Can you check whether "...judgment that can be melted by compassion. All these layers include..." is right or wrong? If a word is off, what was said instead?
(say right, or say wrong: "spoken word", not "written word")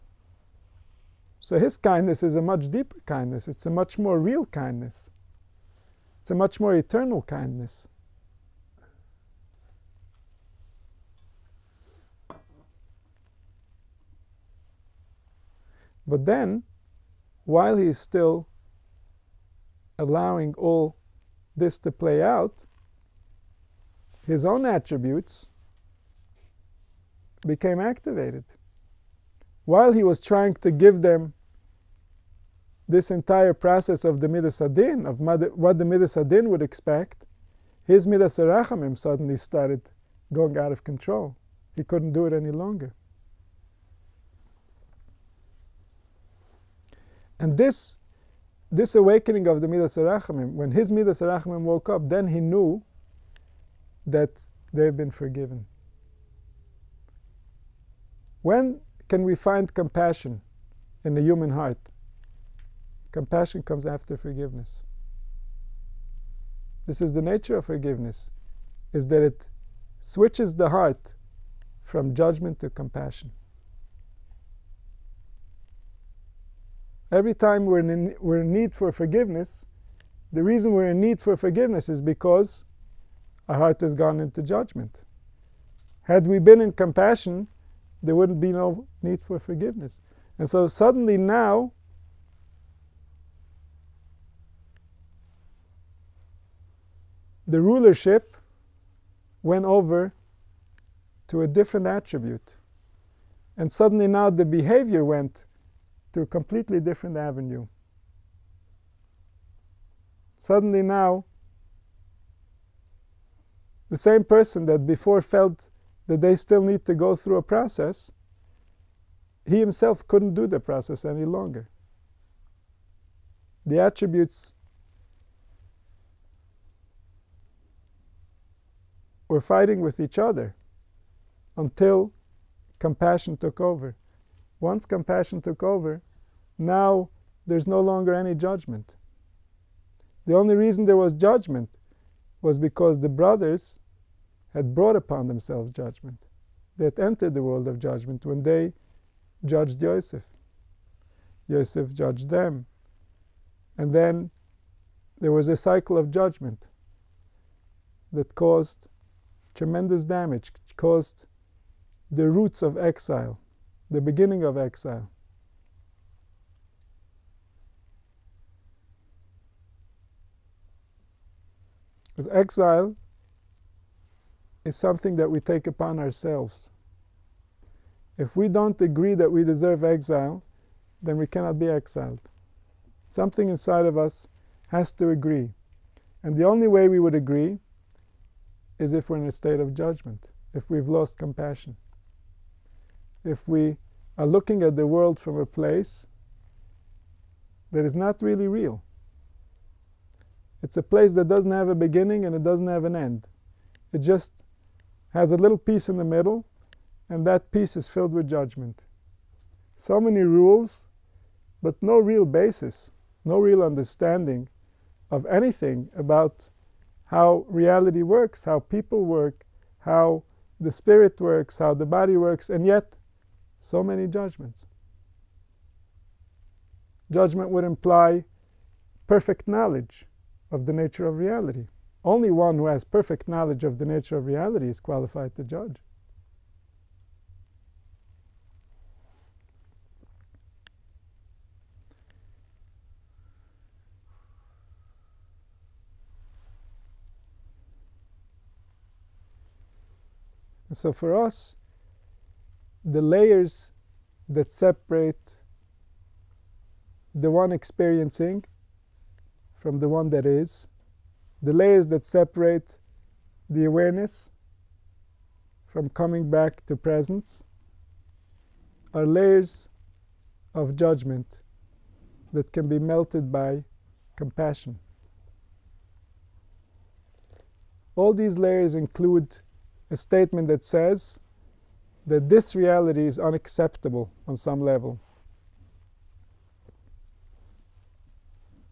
right.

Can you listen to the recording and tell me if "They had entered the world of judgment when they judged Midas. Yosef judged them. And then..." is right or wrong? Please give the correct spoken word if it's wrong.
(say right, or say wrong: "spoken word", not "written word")
wrong: "Yosef", not "Midas".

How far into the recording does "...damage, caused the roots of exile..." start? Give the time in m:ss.
2:40.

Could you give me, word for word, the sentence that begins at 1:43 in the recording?
And suddenly now the behavior went to a completely different avenue.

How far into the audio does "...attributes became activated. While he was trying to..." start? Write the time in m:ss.
0:24.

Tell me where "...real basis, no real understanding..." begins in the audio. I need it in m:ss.
3:31.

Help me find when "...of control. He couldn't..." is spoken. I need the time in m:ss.
0:40.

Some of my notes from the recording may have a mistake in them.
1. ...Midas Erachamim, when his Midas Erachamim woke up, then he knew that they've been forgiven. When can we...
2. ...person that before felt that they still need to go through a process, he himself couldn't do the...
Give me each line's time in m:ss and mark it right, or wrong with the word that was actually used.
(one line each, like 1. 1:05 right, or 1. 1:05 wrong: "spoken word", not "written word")
1. 0:49 right
2. 1:54 right.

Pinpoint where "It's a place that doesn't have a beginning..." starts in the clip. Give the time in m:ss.
3:20.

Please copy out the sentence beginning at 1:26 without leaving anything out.
Had we been in compassion, there wouldn't be no need for forgiveness.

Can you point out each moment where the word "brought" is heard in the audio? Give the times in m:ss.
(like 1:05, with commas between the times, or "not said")
2:24.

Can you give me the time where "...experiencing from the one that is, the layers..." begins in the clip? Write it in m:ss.
4:17.